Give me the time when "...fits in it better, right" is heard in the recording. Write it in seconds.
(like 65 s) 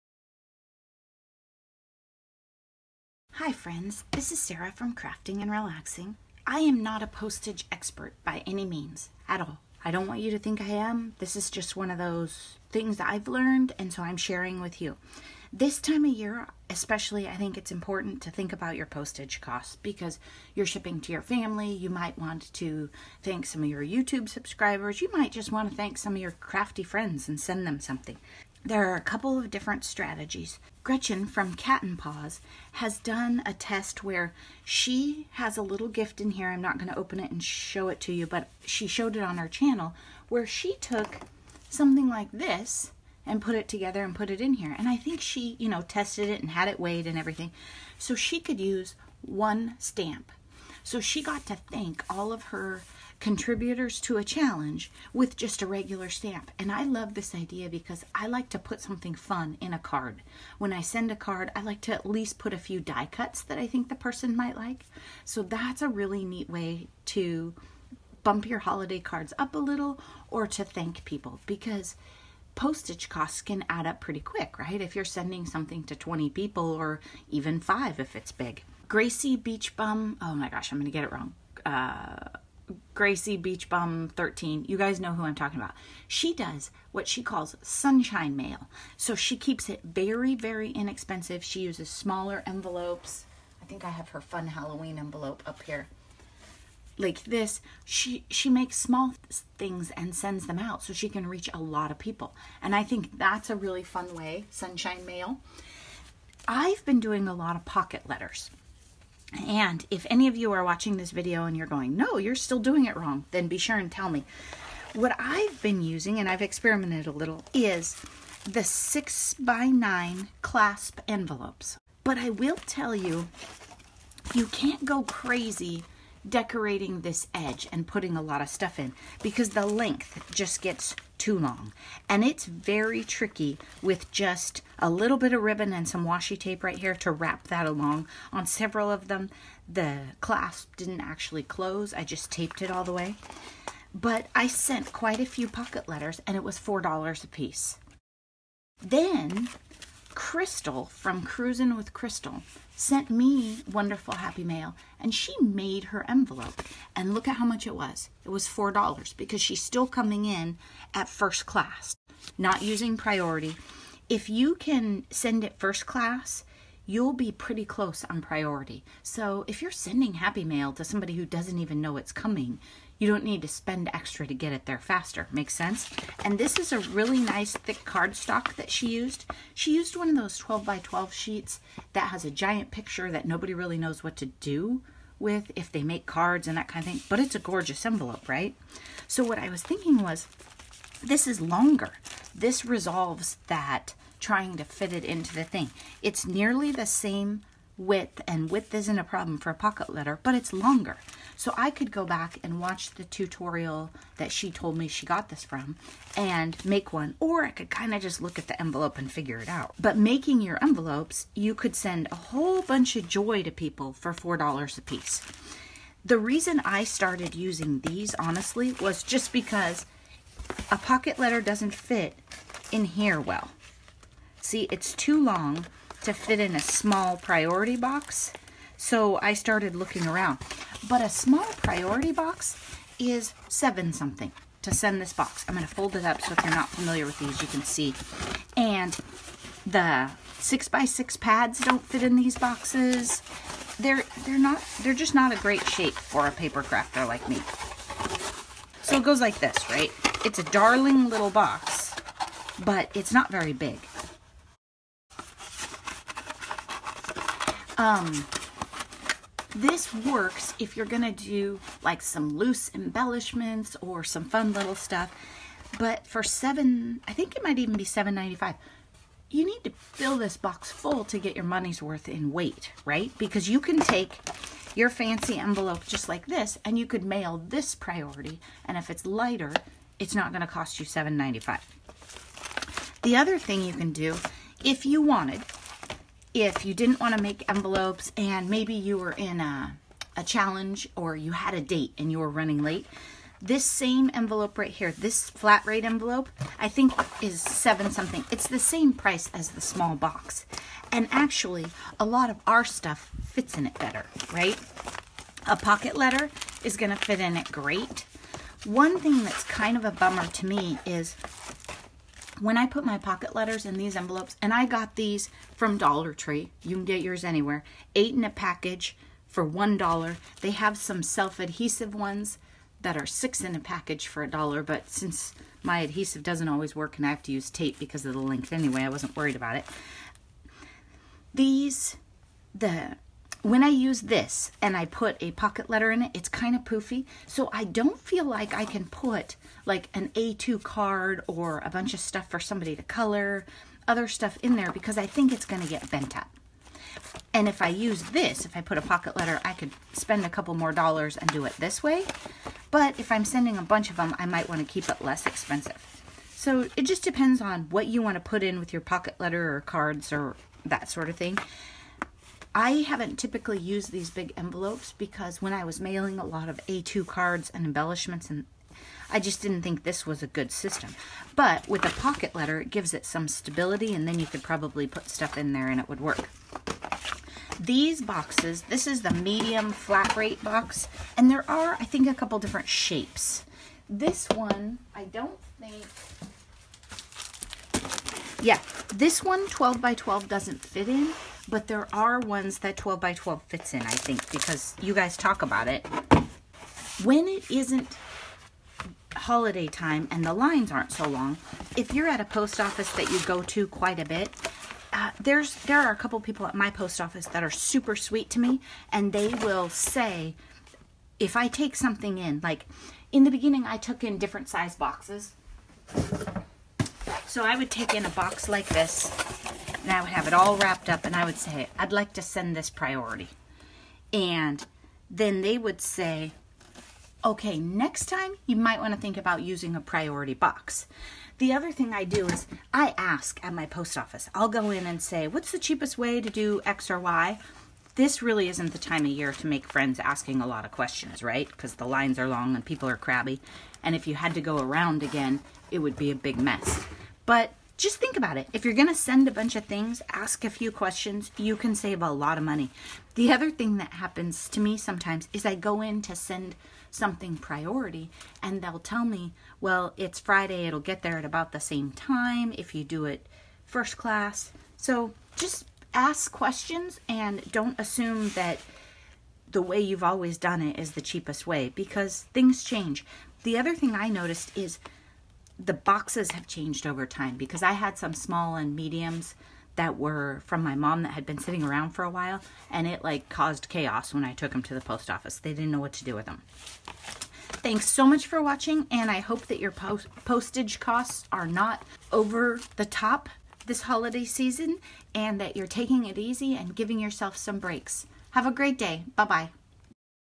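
303 s.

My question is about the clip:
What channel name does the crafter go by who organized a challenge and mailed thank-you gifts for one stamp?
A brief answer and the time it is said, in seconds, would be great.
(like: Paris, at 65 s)
Cat and Paws, at 31 s.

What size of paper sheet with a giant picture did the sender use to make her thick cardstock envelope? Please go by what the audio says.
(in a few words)
12 by 12.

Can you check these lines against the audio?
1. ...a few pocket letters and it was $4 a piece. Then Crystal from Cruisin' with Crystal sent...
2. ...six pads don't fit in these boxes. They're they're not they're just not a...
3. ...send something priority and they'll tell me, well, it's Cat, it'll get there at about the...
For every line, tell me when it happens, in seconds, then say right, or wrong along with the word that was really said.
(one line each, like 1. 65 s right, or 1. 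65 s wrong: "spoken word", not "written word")
1. 145 s right
2. 240 s right
3. 456 s wrong: "Friday", not "Cat".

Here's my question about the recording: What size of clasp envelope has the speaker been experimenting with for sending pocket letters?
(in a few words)
6 by 9.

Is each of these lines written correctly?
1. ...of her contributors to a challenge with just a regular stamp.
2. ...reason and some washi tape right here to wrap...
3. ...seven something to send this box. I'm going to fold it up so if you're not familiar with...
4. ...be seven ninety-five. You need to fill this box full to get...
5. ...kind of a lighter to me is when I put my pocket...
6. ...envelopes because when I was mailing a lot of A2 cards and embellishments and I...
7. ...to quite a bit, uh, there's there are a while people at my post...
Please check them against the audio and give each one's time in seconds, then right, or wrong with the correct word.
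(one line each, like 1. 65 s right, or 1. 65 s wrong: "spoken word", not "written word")
1. 52 s right
2. 135 s wrong: "ribbon", not "reason"
3. 233 s right
4. 267 s right
5. 309 s wrong: "bummer", not "lighter"
6. 364 s right
7. 403 s wrong: "couple", not "while".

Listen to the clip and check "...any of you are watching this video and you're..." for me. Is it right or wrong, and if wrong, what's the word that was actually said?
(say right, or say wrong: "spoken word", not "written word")
right.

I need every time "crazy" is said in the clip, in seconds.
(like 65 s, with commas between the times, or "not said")
125 s.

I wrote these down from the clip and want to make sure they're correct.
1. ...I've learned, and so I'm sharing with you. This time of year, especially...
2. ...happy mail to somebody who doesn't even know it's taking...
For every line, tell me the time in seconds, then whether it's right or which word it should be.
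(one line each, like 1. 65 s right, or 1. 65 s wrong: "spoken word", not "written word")
1. 13 s right
2. 170 s wrong: "coming", not "taking".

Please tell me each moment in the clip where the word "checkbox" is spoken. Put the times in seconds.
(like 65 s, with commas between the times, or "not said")
not said.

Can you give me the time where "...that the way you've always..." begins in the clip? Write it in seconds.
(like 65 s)
468 s.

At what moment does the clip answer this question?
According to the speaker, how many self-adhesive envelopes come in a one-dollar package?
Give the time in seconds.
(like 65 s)
323 s.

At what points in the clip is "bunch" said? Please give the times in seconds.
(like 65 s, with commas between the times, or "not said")
212 s, 341 s, 353 s, 449 s.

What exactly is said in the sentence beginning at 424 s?
And then they would say, okay, next time you might want to think about using a priority box.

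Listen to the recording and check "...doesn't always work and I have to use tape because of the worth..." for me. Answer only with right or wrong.
wrong.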